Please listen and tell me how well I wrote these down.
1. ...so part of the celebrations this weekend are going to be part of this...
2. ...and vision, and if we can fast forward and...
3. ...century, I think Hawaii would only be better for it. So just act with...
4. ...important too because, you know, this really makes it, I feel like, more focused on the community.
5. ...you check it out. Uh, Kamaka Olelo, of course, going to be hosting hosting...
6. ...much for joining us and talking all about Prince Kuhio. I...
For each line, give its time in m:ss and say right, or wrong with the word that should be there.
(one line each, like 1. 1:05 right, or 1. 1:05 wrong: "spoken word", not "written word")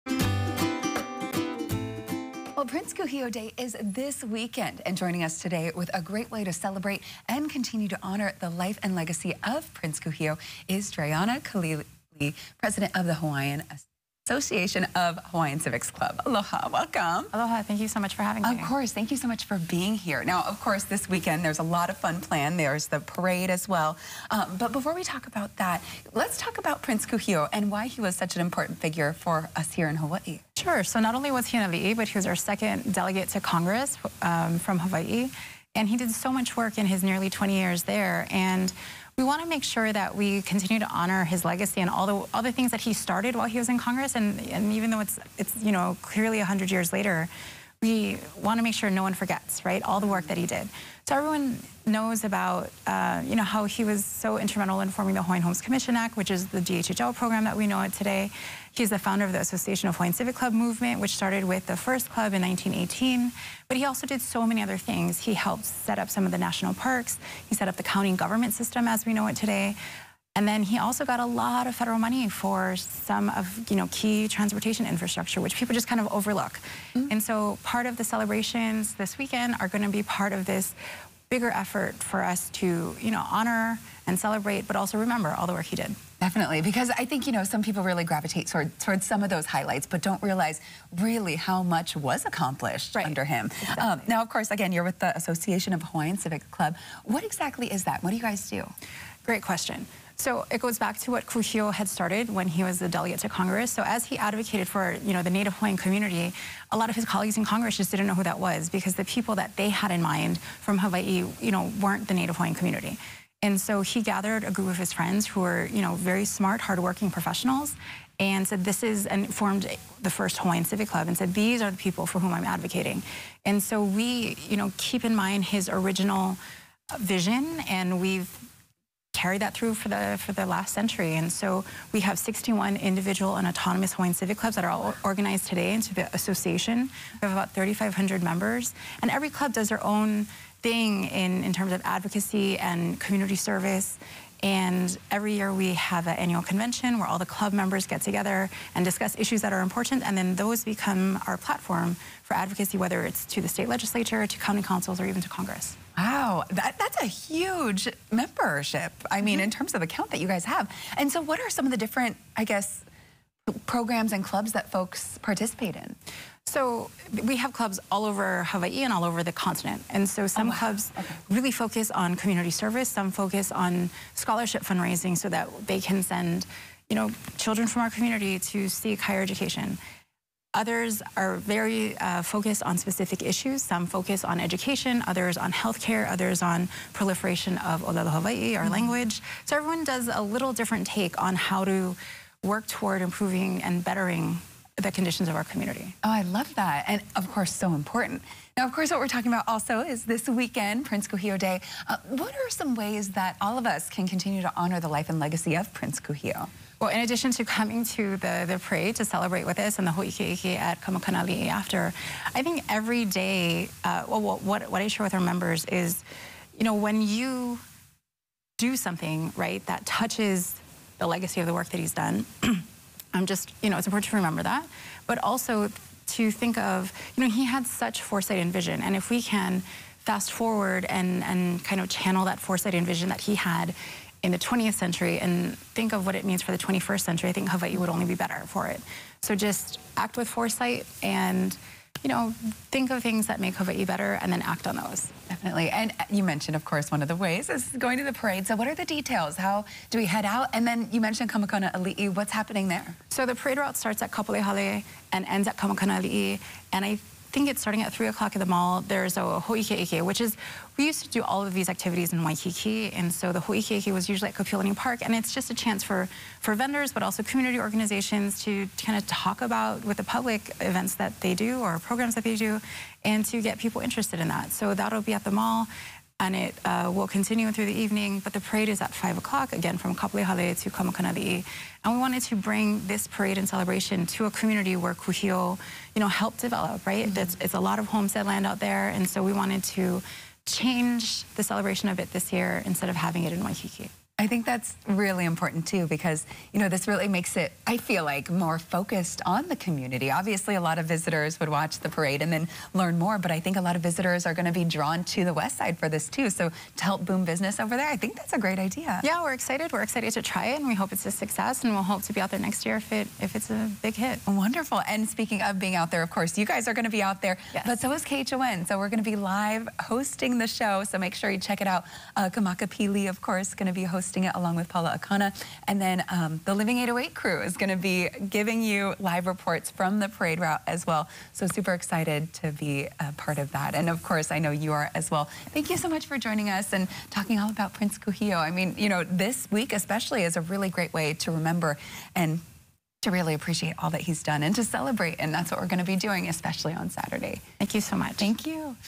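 1. 1:17 right
2. 3:48 right
3. 3:57 right
4. 4:55 right
5. 5:21 wrong: "Pili", not "Olelo"
6. 5:35 right.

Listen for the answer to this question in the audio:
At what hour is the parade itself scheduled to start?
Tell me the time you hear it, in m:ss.
4:38.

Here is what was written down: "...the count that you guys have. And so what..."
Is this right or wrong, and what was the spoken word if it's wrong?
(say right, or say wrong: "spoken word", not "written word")
right.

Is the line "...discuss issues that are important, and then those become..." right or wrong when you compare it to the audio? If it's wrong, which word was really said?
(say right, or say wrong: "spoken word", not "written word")
right.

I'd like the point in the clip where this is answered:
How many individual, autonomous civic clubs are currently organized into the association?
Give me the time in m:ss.
2:12.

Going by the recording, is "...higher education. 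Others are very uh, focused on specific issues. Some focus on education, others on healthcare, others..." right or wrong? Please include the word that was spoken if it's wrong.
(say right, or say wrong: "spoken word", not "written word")
right.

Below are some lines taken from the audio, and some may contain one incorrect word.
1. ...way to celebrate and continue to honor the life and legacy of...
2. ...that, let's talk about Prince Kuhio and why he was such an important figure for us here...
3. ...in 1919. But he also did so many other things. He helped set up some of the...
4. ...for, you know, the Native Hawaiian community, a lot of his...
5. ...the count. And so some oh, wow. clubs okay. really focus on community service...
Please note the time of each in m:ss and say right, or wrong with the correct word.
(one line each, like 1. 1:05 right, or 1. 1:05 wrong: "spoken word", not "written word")
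1. 0:06 right
2. 0:25 right
3. 1:02 wrong: "1918", not "1919"
4. 1:44 right
5. 2:49 wrong: "continent", not "count".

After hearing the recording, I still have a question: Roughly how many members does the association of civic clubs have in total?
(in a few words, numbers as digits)
3,500.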